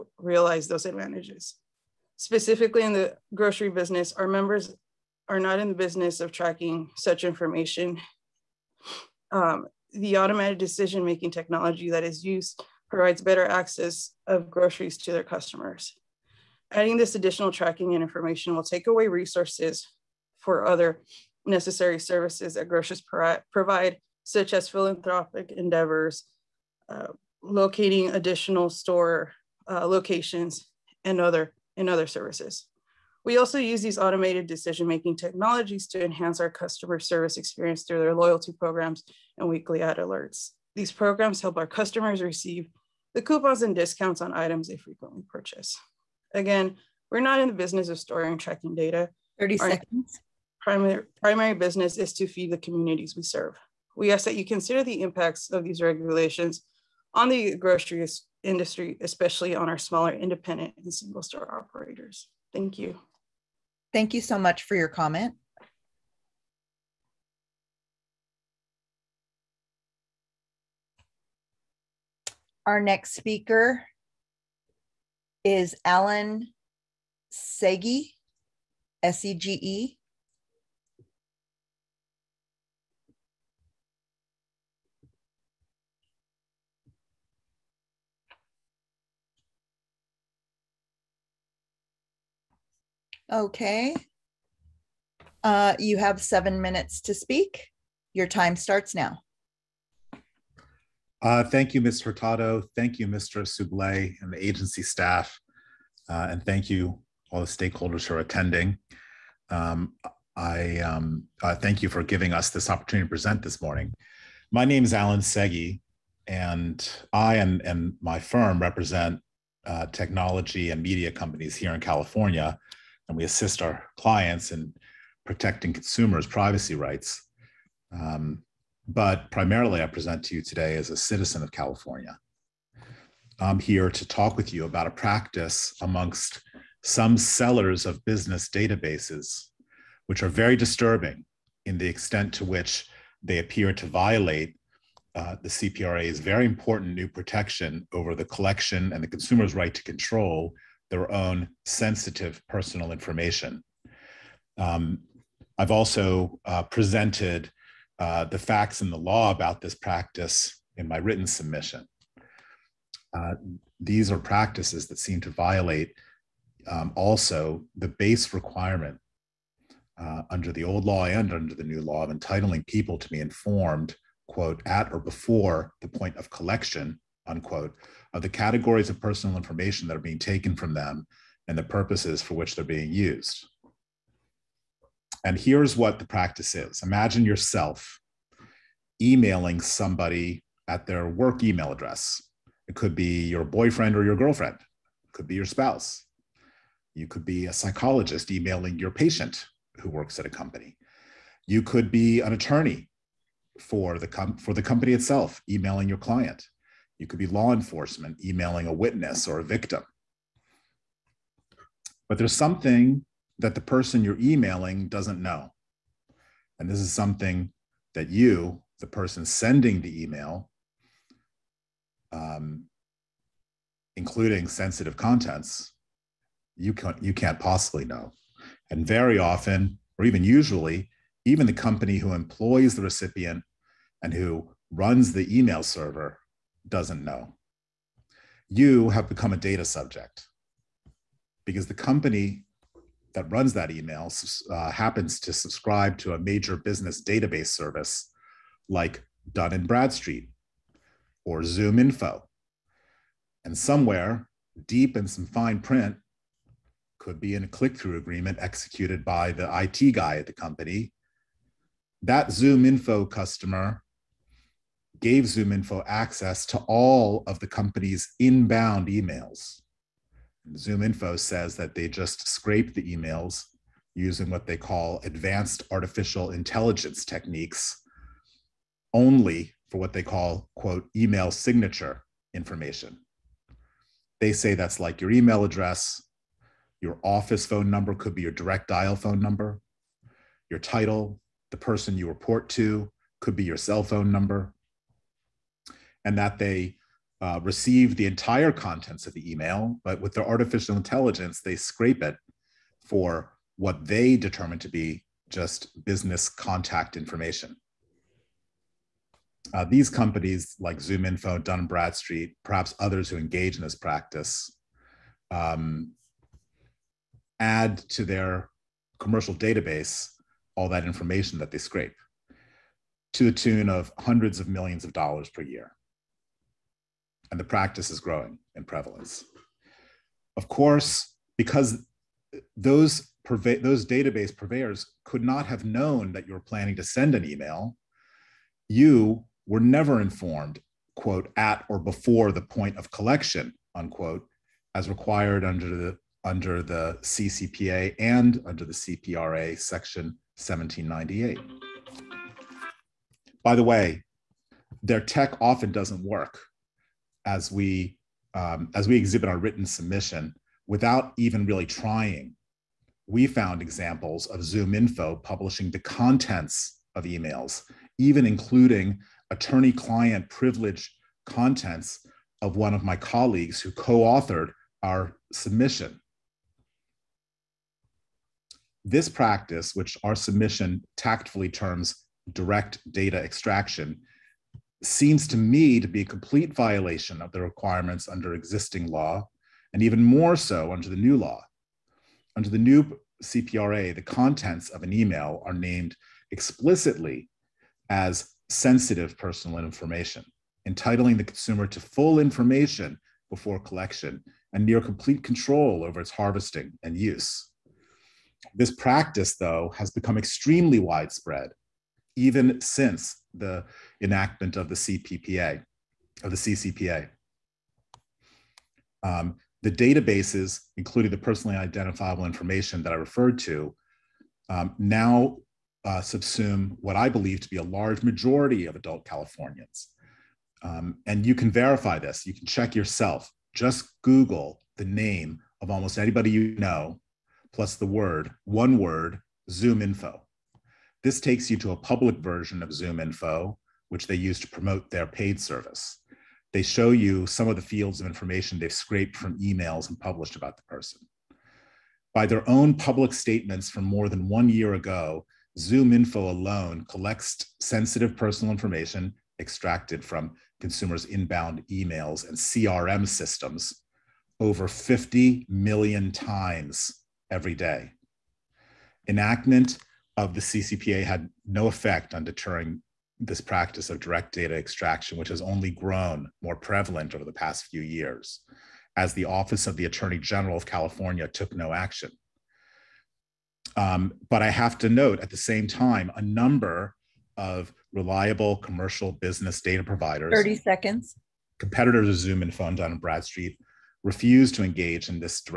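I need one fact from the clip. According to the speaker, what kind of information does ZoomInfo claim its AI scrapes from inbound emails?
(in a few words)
email signature information.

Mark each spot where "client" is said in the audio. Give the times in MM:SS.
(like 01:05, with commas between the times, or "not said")
02:03, 03:25, 06:09.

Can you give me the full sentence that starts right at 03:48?
And very often, or even usually, even the company who employs the recipient and who runs the email server doesn't know.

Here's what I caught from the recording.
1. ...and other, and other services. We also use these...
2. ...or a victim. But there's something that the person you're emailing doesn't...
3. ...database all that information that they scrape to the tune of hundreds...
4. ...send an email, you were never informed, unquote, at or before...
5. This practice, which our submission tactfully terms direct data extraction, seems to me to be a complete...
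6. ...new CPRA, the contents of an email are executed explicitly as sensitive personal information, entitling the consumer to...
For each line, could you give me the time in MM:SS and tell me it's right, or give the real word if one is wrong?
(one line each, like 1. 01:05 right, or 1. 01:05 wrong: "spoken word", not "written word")
1. 00:31 right
2. 03:29 right
3. 05:19 right
4. 05:36 wrong: "quote", not "unquote"
5. 06:18 right
6. 06:32 wrong: "named", not "executed".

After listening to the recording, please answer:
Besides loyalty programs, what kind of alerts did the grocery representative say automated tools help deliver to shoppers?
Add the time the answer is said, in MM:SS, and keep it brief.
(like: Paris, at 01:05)
weekly ad alerts, at 00:39.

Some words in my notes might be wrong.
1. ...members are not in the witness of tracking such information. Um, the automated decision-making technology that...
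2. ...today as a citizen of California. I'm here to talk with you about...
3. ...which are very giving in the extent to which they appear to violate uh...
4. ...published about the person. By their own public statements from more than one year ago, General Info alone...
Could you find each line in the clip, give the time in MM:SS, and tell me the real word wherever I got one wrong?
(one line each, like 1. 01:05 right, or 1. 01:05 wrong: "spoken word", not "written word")
1. 00:04 wrong: "business", not "witness"
2. 02:10 right
3. 02:20 wrong: "disturbing", not "giving"
4. 07:29 wrong: "Zoom", not "General".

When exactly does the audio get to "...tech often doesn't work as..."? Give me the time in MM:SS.
05:55.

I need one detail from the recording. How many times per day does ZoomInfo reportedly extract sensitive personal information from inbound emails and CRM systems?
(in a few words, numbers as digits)
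over 50 million.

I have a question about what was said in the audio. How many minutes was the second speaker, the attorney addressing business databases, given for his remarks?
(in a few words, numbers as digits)
7.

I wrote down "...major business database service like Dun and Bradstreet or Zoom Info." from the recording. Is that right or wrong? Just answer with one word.
right.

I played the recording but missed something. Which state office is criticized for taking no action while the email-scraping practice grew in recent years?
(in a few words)
Office of the Attorney General.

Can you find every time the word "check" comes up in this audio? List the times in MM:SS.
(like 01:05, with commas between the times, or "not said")
07:12.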